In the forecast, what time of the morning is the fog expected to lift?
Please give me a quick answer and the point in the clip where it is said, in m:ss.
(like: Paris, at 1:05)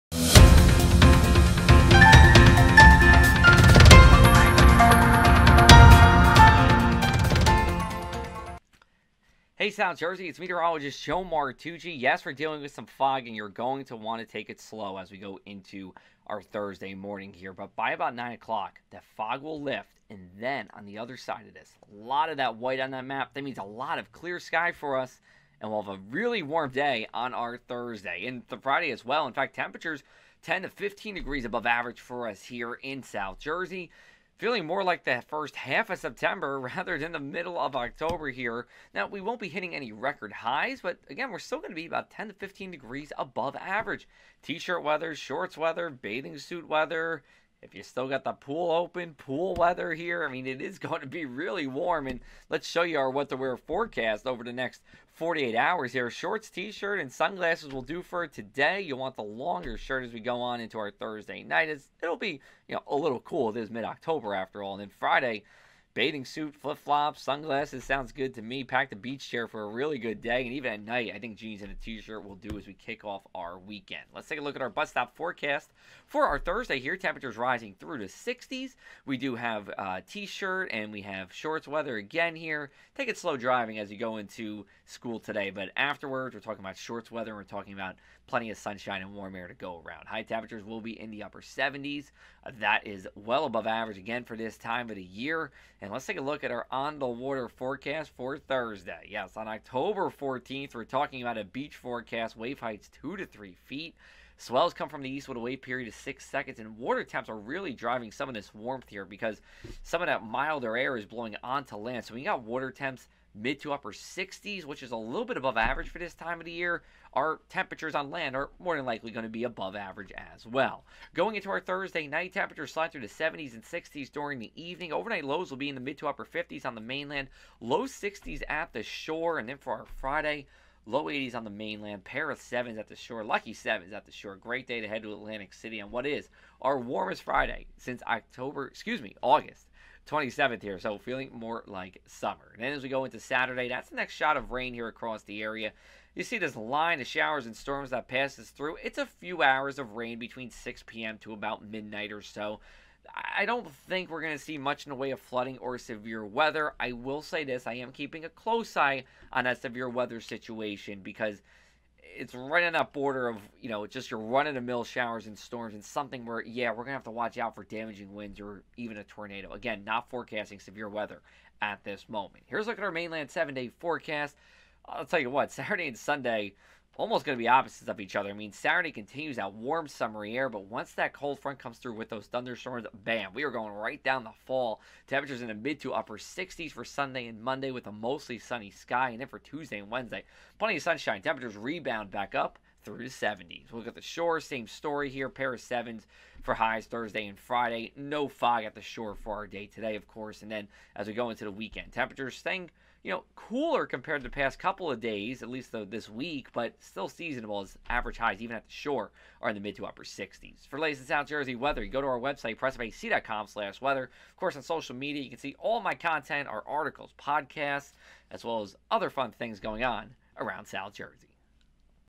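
9 o'clock, at 0:18.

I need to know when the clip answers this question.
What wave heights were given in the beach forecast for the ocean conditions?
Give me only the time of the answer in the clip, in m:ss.
1:43.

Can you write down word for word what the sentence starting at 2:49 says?
Again, not forecasting severe weather at this moment.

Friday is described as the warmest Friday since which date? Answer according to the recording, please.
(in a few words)
August 27th.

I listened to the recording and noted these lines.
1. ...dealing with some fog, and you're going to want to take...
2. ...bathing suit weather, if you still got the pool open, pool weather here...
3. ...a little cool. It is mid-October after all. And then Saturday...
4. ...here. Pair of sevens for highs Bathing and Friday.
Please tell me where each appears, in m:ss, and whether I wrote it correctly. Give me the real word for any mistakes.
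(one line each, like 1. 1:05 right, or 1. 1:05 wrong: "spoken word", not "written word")
1. 0:12 right
2. 0:45 right
3. 1:02 wrong: "Friday", not "Saturday"
4. 3:15 wrong: "Thursday", not "Bathing".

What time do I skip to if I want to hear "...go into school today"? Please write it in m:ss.
1:23.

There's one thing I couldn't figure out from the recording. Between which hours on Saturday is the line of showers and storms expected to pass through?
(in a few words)
6 p.m. to midnight.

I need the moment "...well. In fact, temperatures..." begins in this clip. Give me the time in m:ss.
0:29.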